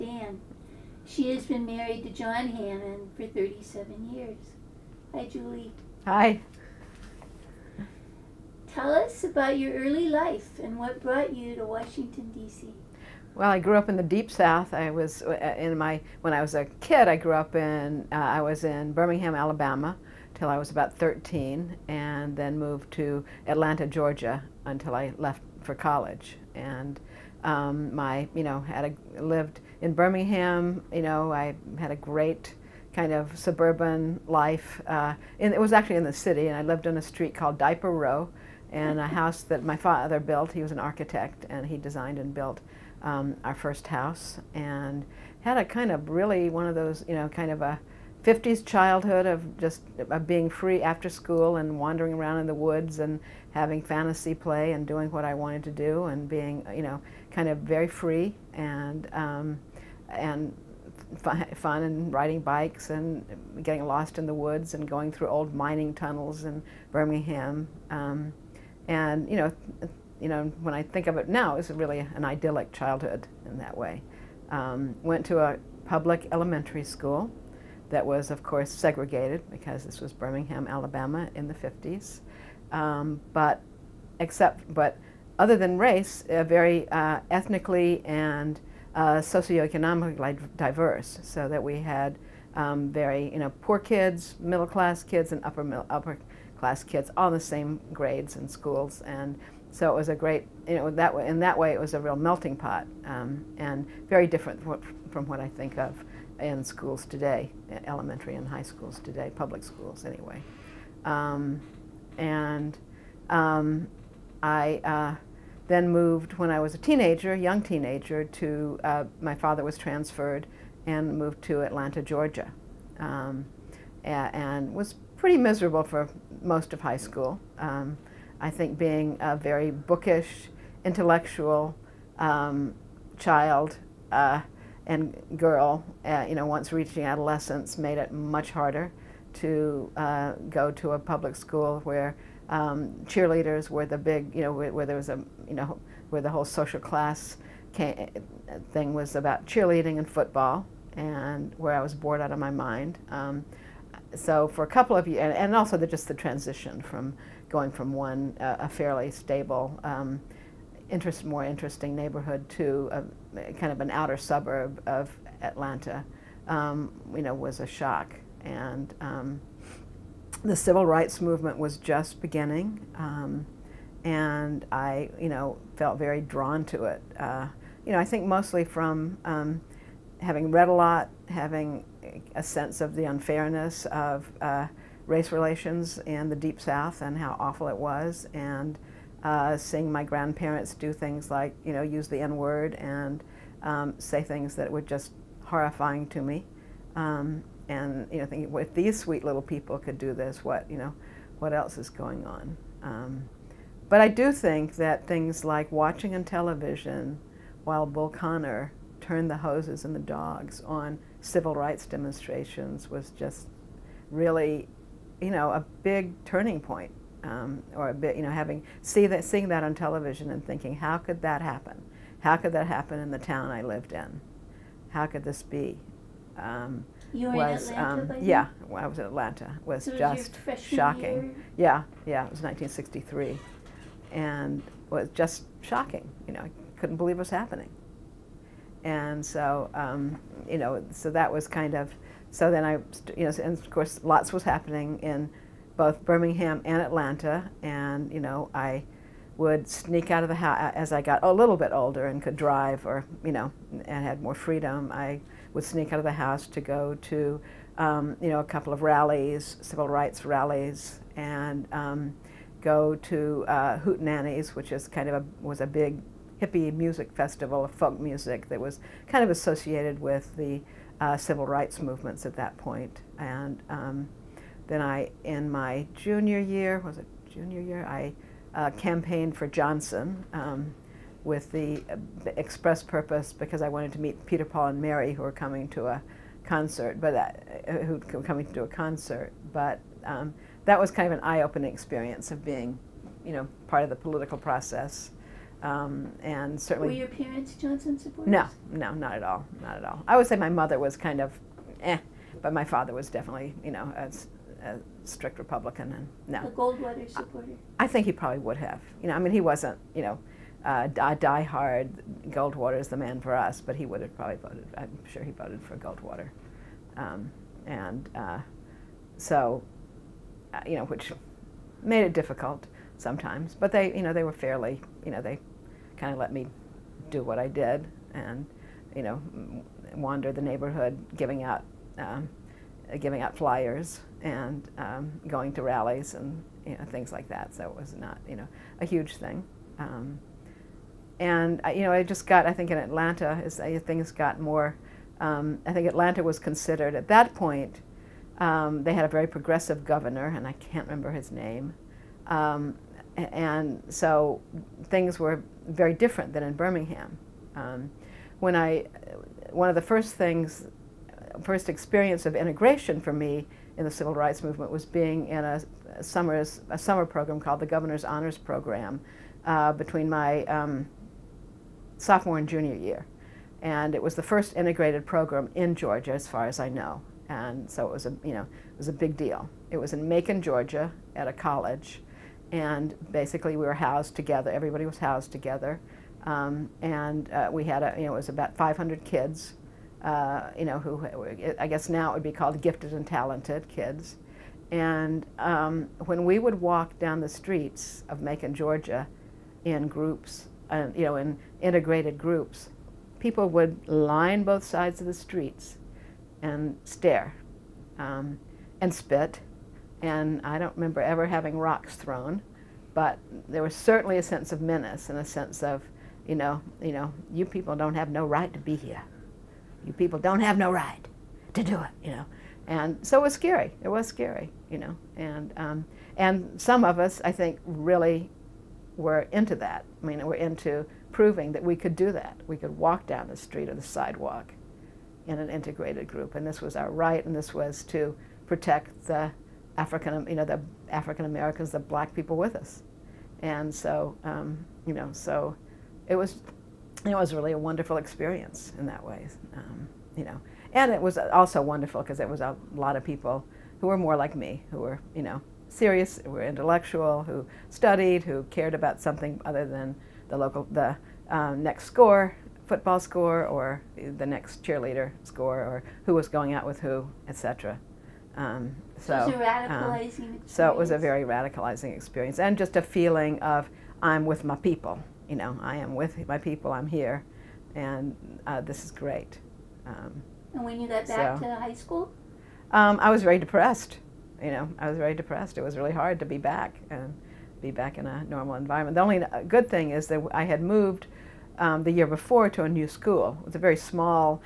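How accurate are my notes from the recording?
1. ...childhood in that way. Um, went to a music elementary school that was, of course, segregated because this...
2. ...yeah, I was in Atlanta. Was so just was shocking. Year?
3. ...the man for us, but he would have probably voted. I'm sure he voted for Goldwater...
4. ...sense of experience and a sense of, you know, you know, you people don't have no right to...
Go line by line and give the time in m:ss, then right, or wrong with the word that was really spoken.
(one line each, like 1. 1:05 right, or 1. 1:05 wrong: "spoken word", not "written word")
1. 1:12 wrong: "public", not "music"
2. 3:48 right
3. 5:12 right
4. 6:54 wrong: "menace", not "experience".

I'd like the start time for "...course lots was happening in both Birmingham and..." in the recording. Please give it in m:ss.
4:03.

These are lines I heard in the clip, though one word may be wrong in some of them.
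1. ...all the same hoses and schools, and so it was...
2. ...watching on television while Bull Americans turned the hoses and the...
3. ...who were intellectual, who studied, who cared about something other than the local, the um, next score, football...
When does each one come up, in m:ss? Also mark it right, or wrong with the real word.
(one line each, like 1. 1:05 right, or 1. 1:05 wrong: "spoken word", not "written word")
1. 1:37 wrong: "grades", not "hoses"
2. 3:25 wrong: "Connor", not "Americans"
3. 7:36 right.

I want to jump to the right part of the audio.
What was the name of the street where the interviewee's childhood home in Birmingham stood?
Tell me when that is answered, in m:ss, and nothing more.
0:37.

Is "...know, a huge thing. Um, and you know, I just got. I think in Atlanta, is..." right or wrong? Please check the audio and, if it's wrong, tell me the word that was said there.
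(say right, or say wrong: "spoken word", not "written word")
right.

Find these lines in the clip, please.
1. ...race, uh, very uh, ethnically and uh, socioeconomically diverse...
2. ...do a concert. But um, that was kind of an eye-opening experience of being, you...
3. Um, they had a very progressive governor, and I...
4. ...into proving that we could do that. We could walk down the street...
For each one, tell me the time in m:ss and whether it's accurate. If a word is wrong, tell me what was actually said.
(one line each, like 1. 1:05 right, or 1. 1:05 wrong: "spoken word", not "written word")
1. 1:25 right
2. 4:48 right
3. 5:48 right
4. 7:10 right.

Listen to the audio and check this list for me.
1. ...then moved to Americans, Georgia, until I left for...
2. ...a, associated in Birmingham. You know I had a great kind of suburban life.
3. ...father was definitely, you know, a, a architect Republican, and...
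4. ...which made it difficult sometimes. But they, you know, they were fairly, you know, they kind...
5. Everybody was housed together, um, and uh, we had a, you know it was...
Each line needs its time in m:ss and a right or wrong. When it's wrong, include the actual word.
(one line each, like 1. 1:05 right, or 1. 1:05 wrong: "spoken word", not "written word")
1. 0:22 wrong: "Atlanta", not "Americans"
2. 0:29 wrong: "lived", not "associated"
3. 5:02 wrong: "strict", not "architect"
4. 5:20 right
5. 6:24 right.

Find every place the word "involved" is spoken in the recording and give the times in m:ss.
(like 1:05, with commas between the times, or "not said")
not said.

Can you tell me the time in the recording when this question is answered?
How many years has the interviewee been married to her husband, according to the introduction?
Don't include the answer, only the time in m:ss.
0:03.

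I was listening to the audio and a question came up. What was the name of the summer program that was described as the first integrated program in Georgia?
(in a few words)
Governor's Honors Program.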